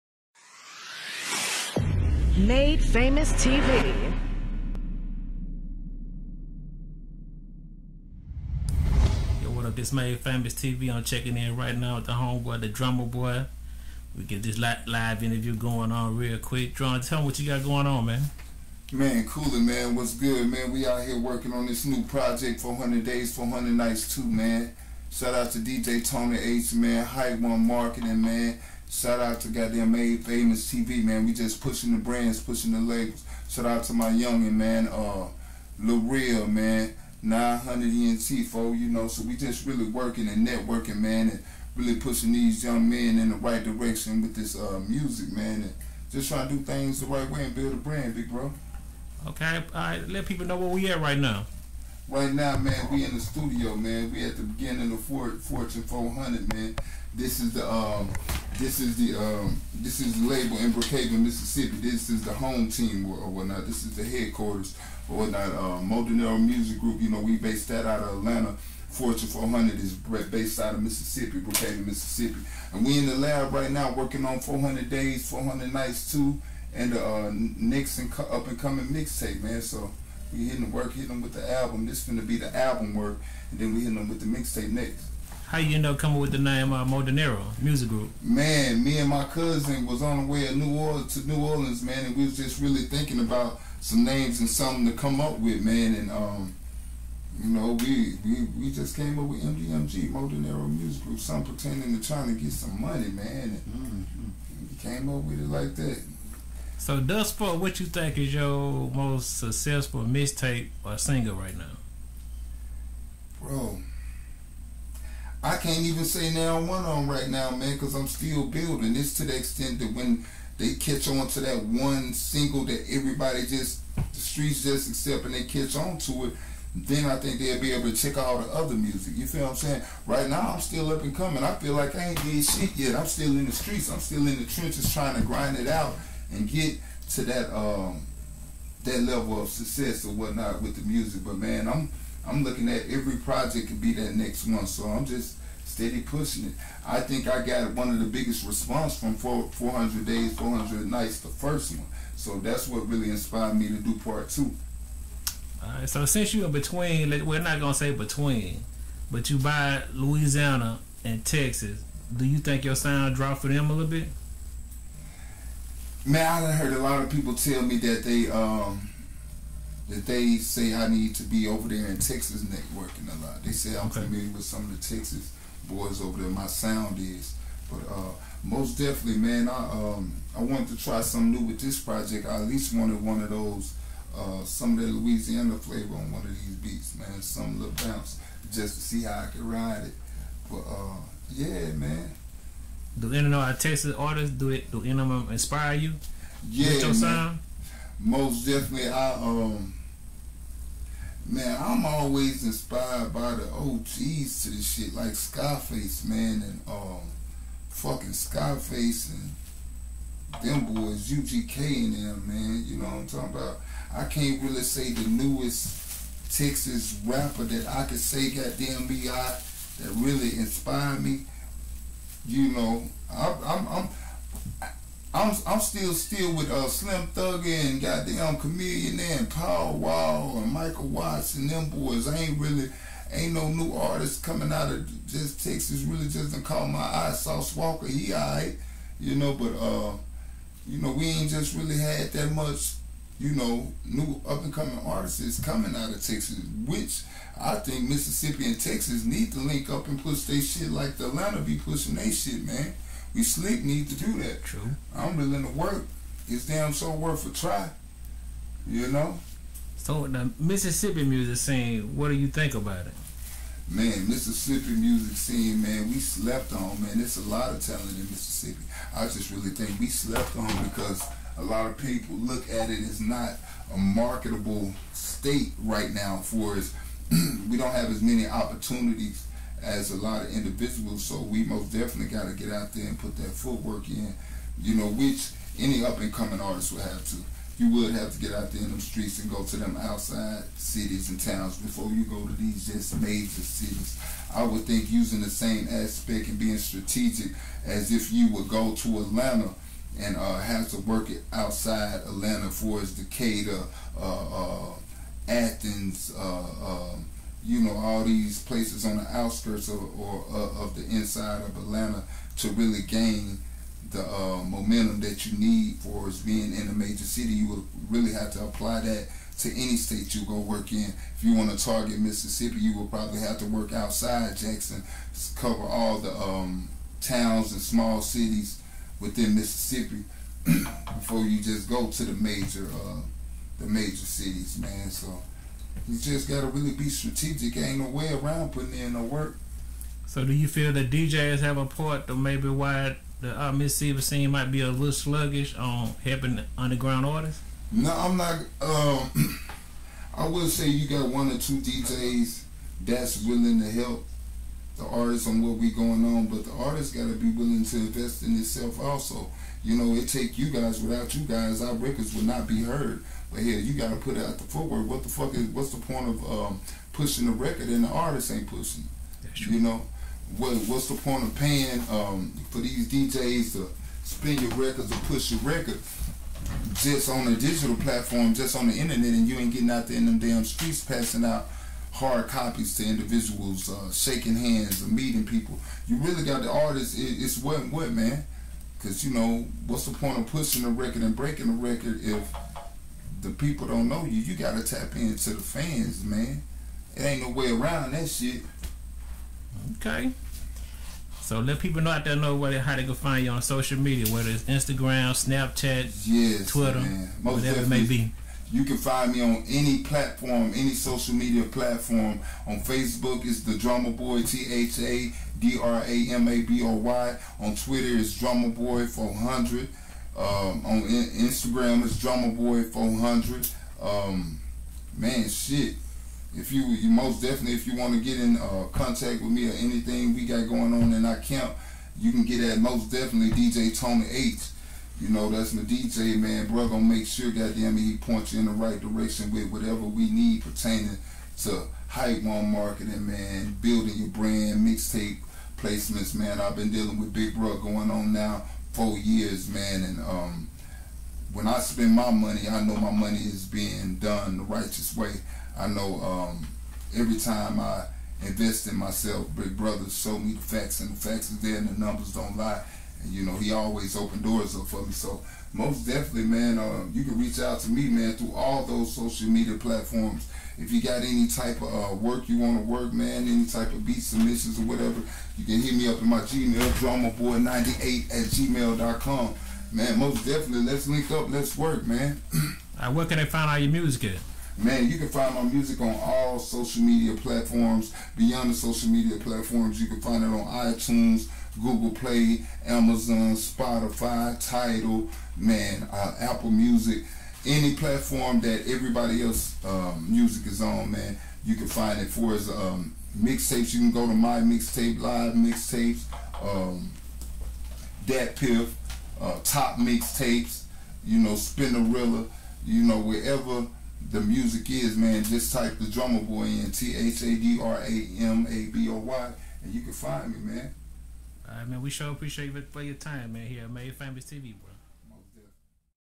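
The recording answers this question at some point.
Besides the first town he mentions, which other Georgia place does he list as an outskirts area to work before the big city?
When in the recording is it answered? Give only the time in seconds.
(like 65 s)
305 s.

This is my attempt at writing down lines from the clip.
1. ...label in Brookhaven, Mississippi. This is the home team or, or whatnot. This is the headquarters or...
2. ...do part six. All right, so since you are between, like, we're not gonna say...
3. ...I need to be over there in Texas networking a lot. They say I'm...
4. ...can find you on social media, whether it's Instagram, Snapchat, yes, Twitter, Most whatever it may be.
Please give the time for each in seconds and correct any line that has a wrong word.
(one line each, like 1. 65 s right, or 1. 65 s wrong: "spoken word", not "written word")
1. 60 s right
2. 153 s wrong: "two", not "six"
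3. 170 s right
4. 402 s right.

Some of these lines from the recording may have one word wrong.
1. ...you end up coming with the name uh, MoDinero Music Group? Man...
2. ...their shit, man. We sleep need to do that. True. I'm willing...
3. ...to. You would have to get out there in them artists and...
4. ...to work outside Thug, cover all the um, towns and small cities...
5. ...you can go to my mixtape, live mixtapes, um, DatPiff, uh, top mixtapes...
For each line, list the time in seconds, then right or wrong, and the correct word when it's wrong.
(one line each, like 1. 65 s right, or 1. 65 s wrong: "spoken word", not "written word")
1. 85 s right
2. 251 s right
3. 287 s wrong: "streets", not "artists"
4. 323 s wrong: "Jackson", not "Thug"
5. 503 s right.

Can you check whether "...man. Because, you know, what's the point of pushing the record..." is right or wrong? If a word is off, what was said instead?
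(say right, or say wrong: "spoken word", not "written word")
right.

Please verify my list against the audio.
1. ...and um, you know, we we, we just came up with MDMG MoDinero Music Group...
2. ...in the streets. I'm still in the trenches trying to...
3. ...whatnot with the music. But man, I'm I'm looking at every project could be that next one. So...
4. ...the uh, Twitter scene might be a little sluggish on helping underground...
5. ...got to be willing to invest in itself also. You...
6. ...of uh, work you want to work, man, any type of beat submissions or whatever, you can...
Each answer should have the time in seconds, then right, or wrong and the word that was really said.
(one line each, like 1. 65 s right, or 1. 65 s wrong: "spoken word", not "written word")
1. 95 s right
2. 133 s right
3. 140 s right
4. 343 s wrong: "Mississippi", not "Twitter"
5. 356 s right
6. 471 s right.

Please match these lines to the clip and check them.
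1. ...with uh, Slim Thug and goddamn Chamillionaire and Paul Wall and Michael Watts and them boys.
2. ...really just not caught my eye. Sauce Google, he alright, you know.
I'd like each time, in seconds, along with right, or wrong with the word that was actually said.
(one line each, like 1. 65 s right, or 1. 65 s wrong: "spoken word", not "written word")
1. 226 s right
2. 235 s wrong: "Walker", not "Google".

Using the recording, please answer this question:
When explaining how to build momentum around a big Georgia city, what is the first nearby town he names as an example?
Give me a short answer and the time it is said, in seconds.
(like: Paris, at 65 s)
Decatur, at 302 s.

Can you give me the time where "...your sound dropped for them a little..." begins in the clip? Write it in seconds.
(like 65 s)
162 s.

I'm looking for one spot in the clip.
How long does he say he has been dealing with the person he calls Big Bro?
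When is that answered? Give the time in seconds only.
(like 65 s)
448 s.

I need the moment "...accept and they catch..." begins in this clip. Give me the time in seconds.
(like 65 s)
124 s.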